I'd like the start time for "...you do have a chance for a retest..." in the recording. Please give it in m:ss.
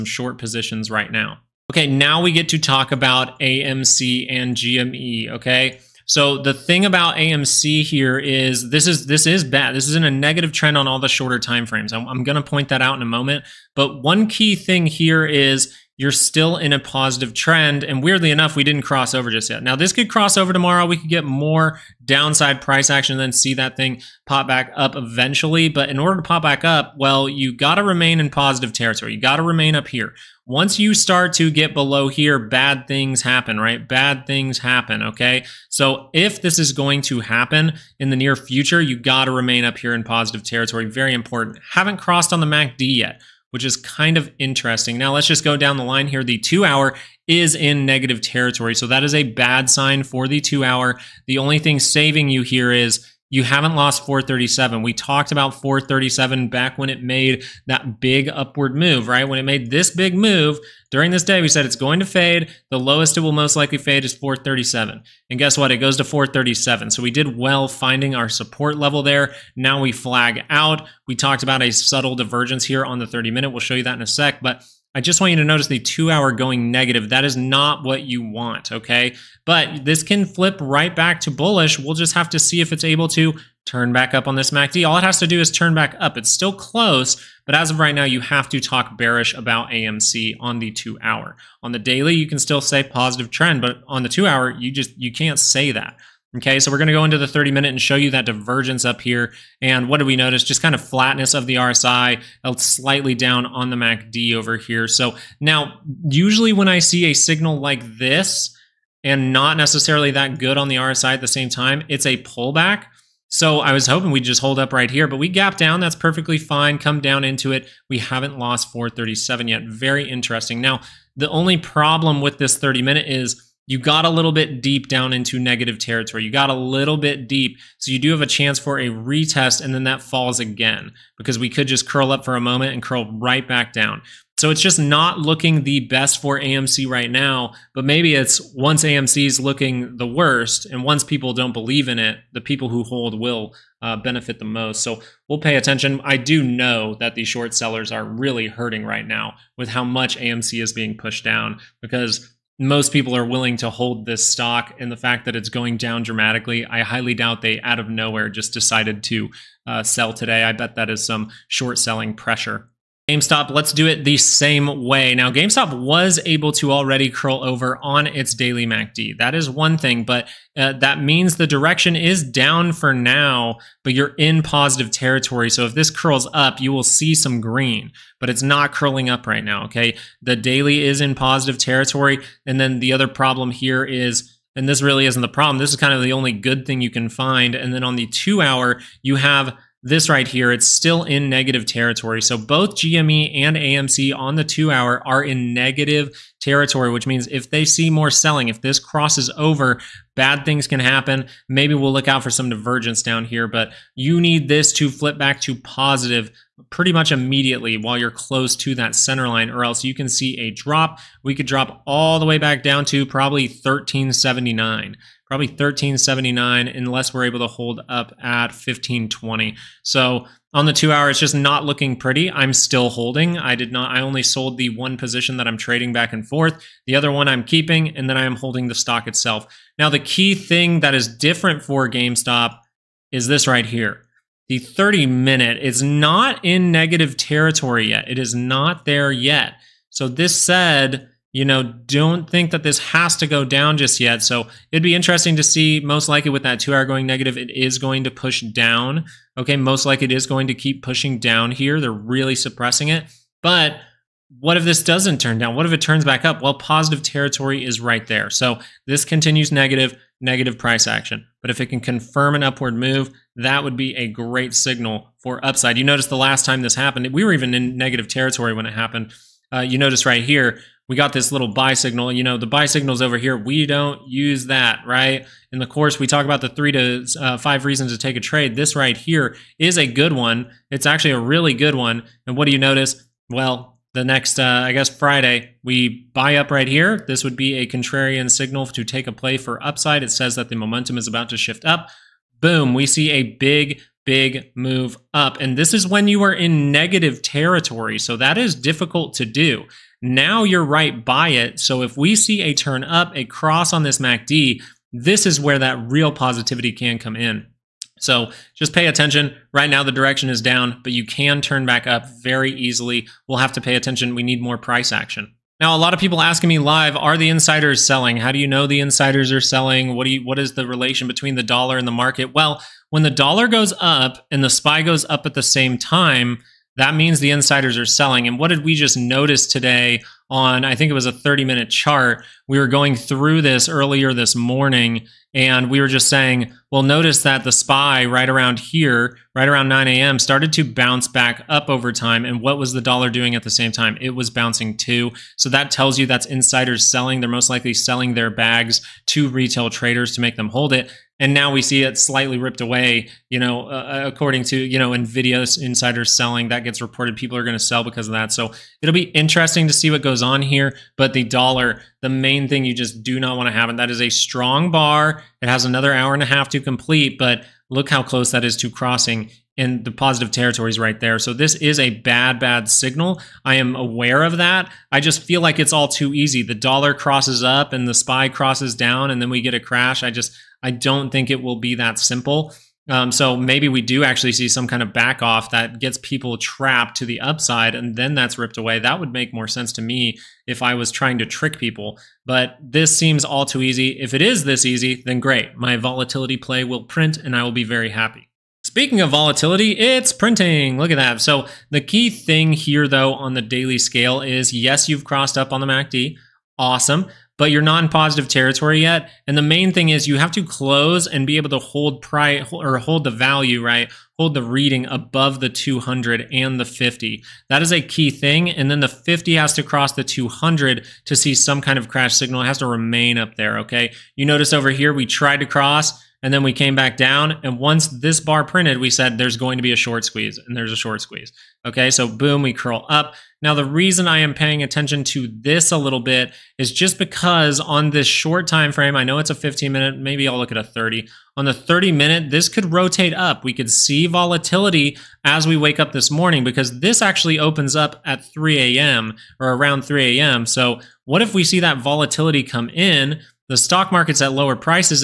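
2:07.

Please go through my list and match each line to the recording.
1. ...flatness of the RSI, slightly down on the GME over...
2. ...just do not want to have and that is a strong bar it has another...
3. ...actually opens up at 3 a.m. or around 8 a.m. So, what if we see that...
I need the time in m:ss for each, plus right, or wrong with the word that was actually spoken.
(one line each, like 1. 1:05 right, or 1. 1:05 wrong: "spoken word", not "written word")
1. 1:40 wrong: "MACD", not "GME"
2. 6:02 right
3. 7:27 wrong: "3", not "8".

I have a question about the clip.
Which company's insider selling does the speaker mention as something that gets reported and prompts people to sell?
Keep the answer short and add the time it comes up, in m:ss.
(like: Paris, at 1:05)
Nvidia, at 5:54.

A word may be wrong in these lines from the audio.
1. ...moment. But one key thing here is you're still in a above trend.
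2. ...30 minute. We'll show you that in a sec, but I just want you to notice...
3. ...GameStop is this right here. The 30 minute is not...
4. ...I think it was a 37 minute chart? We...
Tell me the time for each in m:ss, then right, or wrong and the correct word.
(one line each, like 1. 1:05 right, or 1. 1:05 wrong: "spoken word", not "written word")
1. 0:13 wrong: "positive", not "above"
2. 1:13 right
3. 3:51 right
4. 5:30 wrong: "30", not "37".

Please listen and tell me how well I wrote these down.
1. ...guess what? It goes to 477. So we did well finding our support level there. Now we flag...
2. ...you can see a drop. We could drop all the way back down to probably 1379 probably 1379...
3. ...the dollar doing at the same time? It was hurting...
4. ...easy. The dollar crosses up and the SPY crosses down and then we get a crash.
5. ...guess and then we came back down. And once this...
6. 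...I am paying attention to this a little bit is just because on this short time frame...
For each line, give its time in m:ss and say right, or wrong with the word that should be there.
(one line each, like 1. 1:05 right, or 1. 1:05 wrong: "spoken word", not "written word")
1. 1:05 wrong: "437", not "477"
2. 3:29 right
3. 5:42 wrong: "bouncing", not "hurting"
4. 6:16 right
5. 7:05 wrong: "cross", not "guess"
6. 7:14 right.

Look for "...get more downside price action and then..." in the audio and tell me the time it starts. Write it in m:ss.
0:21.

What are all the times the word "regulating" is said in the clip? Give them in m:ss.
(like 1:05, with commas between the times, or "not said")
not said.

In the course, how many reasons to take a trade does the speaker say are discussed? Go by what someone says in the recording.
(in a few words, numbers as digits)
3 to 5.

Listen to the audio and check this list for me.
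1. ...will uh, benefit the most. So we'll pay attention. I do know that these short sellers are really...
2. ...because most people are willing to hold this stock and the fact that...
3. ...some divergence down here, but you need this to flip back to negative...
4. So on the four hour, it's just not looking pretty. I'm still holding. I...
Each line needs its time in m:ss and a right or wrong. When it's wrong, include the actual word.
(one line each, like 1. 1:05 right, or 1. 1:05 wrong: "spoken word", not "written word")
1. 2:23 right
2. 2:31 right
3. 3:22 wrong: "positive", not "negative"
4. 3:39 wrong: "two", not "four".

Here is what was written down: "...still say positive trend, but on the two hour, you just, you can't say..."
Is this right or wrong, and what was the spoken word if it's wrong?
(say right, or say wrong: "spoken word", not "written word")
right.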